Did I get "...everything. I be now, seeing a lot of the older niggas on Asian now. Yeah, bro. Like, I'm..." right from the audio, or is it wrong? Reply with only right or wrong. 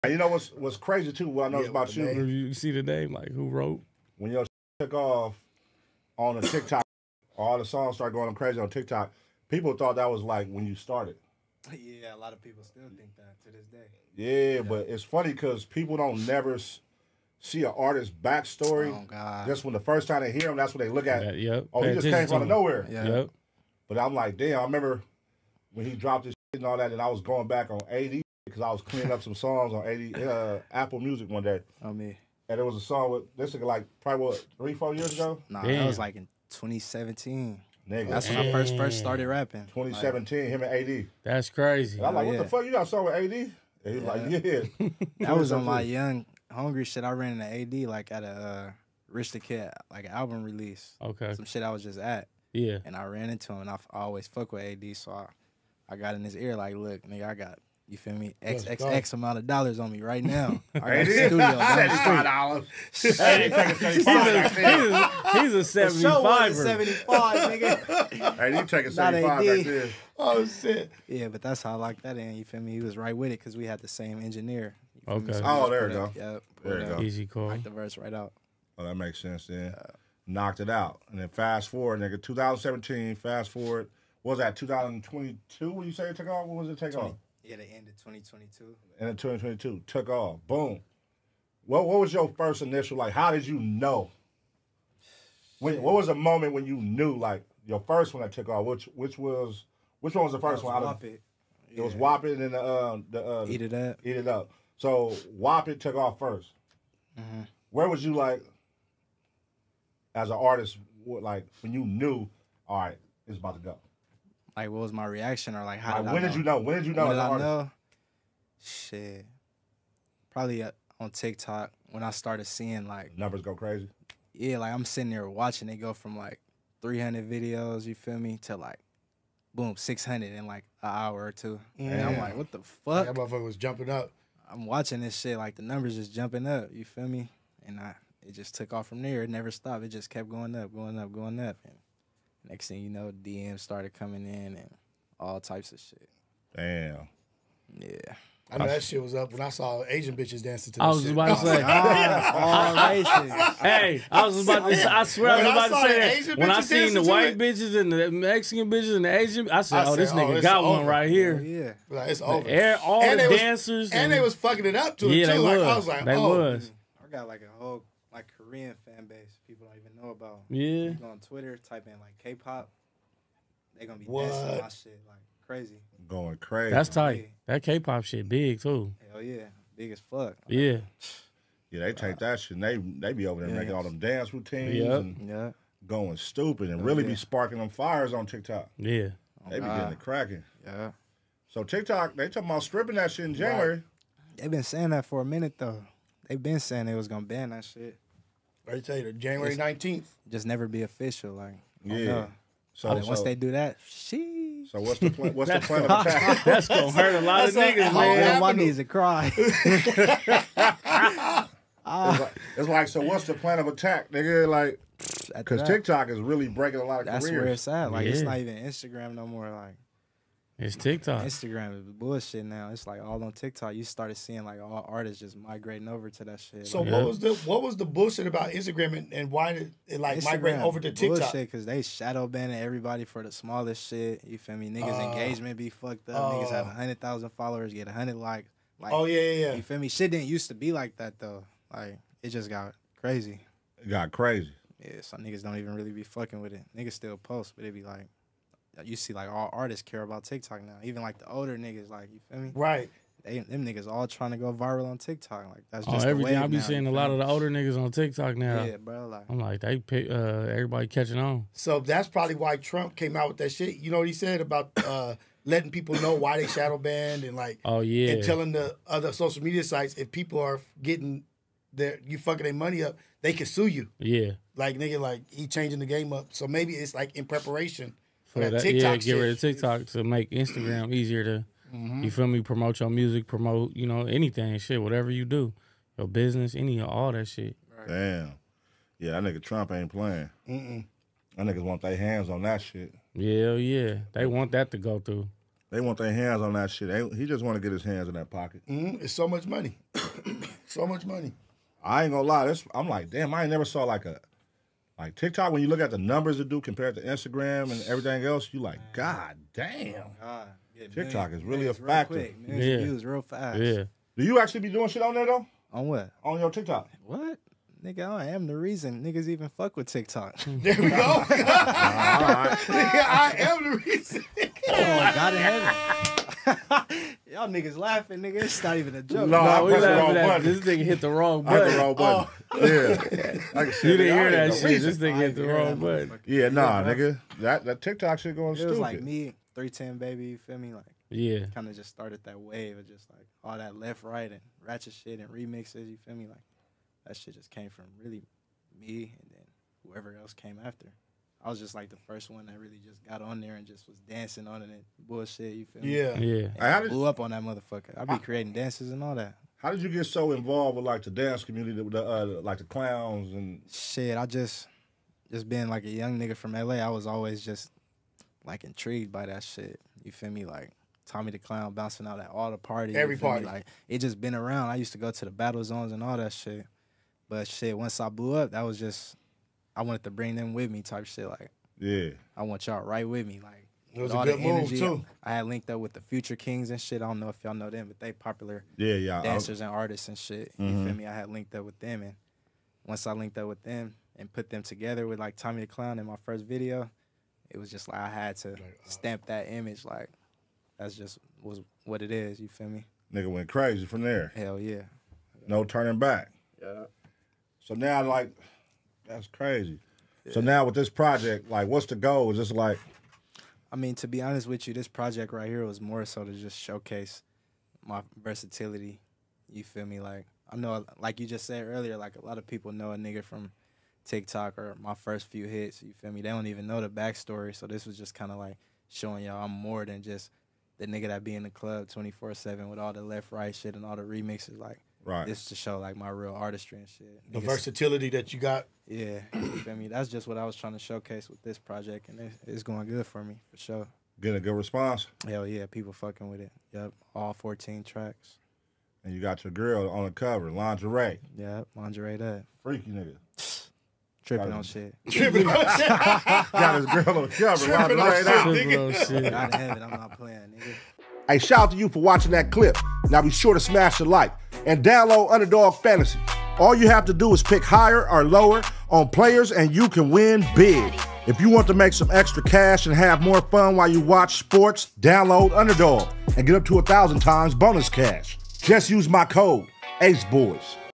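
wrong.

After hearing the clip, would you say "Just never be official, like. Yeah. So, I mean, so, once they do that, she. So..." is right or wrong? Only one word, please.
right.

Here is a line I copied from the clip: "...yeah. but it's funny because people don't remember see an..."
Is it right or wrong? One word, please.
wrong.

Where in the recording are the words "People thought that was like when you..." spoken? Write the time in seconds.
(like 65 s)
9 s.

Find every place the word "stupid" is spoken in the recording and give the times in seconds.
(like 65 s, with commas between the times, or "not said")
186 s, 338 s.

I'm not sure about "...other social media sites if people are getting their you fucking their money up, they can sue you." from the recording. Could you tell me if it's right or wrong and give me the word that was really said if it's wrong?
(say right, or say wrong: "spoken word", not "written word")
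right.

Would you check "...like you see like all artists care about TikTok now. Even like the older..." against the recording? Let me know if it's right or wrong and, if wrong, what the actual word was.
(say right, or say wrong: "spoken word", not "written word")
right.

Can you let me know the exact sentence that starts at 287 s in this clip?
Damn, yeah, that nigga Trump ain't playing.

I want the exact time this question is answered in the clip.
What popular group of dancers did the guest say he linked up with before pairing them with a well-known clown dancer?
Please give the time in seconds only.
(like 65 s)
386 s.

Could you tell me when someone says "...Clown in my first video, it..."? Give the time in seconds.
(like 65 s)
395 s.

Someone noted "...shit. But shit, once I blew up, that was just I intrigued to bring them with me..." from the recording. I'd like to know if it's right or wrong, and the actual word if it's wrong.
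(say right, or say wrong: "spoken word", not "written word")
wrong: "wanted", not "intrigued".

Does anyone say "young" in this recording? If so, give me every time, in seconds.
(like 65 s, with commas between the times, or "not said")
45 s, 365 s.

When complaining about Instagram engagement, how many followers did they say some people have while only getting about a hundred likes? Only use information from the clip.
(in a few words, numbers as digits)
100,000.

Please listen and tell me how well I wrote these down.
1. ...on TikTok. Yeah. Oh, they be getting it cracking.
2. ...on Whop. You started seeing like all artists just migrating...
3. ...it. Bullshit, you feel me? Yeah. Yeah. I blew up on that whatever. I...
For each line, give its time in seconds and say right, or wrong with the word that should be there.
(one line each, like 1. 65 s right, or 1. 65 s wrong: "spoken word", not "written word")
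1. 188 s right
2. 223 s wrong: "TikTok", not "Whop"
3. 354 s wrong: "motherfucker", not "whatever".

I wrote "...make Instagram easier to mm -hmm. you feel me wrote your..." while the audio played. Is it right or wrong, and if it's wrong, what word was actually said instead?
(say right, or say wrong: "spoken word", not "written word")
wrong: "promote", not "wrote".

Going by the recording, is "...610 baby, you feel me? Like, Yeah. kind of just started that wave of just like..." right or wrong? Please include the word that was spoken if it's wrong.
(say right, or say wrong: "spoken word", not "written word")
wrong: "310", not "610".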